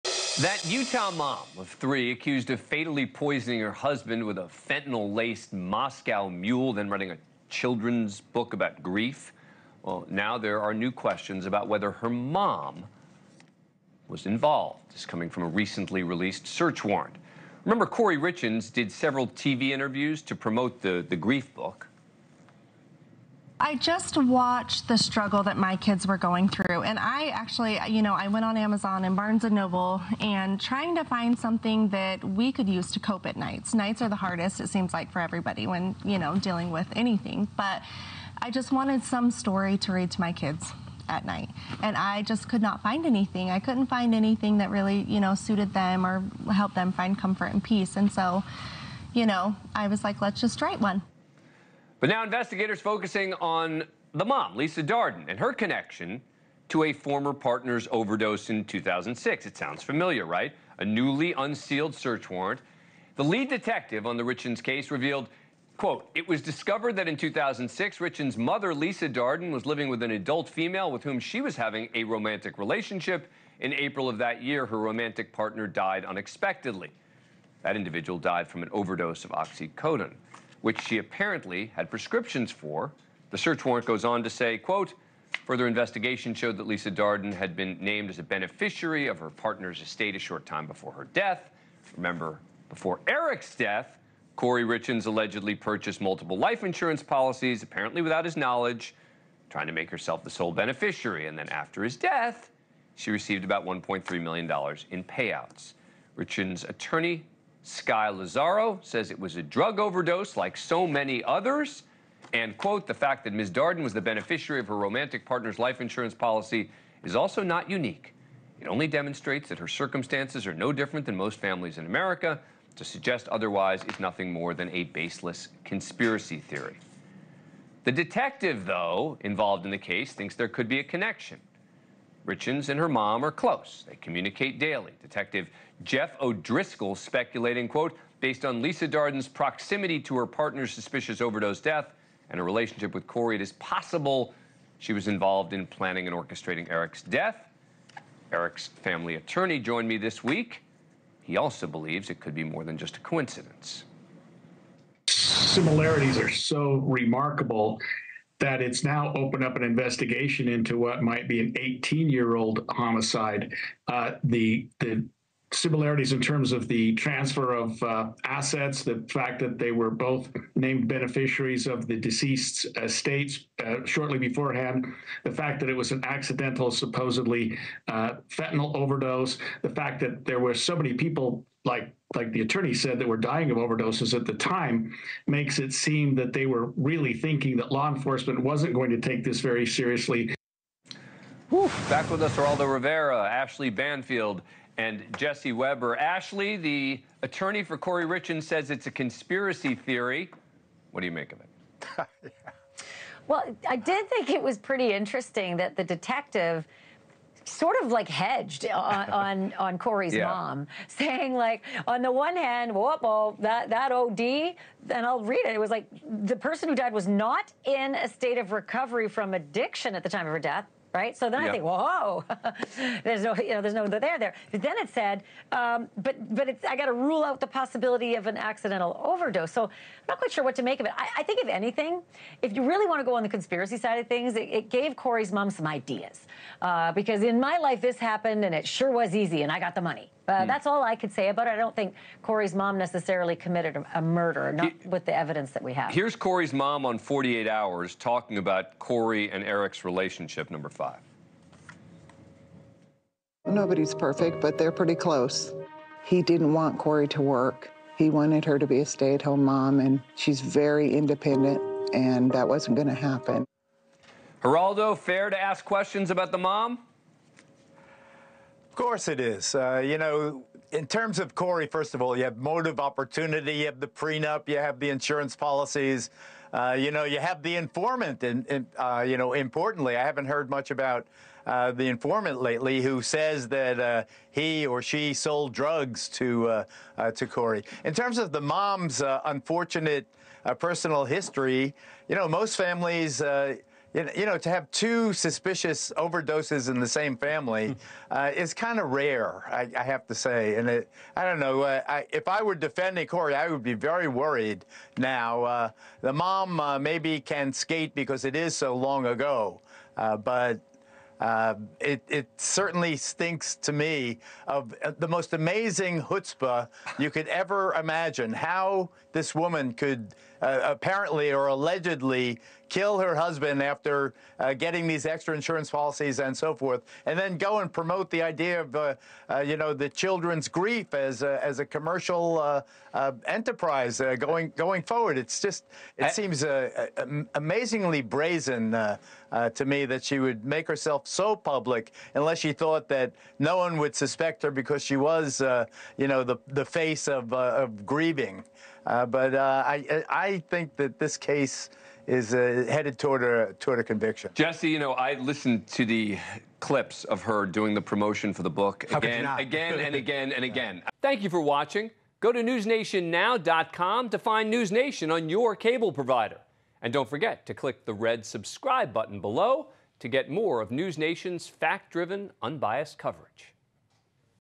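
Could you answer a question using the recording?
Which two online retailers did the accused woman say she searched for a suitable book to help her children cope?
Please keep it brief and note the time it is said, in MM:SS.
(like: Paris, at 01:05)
Amazon and Barnes and Noble, at 00:28.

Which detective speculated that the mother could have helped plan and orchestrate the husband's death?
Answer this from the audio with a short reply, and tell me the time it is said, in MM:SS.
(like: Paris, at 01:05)
Jeff O'Driscoll, at 02:15.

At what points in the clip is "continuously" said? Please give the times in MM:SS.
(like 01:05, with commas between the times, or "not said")
not said.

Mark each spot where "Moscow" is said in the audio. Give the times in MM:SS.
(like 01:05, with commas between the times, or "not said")
00:05.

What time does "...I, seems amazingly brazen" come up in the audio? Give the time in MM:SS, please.
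05:36.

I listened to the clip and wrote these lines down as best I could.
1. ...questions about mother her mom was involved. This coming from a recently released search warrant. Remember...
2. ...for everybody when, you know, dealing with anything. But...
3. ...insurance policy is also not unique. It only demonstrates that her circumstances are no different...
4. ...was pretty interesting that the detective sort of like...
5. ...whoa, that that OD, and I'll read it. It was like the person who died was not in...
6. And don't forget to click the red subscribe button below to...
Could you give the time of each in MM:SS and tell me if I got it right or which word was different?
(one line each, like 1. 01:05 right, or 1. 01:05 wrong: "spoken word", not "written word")
1. 00:10 wrong: "whether", not "mother"
2. 00:35 right
3. 01:55 right
4. 03:24 right
5. 03:32 right
6. 06:06 right.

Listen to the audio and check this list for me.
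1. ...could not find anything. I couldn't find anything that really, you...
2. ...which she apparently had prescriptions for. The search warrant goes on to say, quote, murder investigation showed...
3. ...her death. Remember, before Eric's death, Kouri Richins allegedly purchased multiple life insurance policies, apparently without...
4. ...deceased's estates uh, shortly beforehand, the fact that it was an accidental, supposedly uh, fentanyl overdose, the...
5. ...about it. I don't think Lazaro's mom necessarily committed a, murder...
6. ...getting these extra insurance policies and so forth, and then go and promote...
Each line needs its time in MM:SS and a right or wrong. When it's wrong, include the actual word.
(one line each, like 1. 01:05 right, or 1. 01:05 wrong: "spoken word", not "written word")
1. 00:42 right
2. 01:20 wrong: "further", not "murder"
3. 01:30 right
4. 02:51 right
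5. 04:01 wrong: "Kouri", not "Lazaro"
6. 05:24 right.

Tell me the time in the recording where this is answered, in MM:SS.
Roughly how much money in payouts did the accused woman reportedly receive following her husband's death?
01:43.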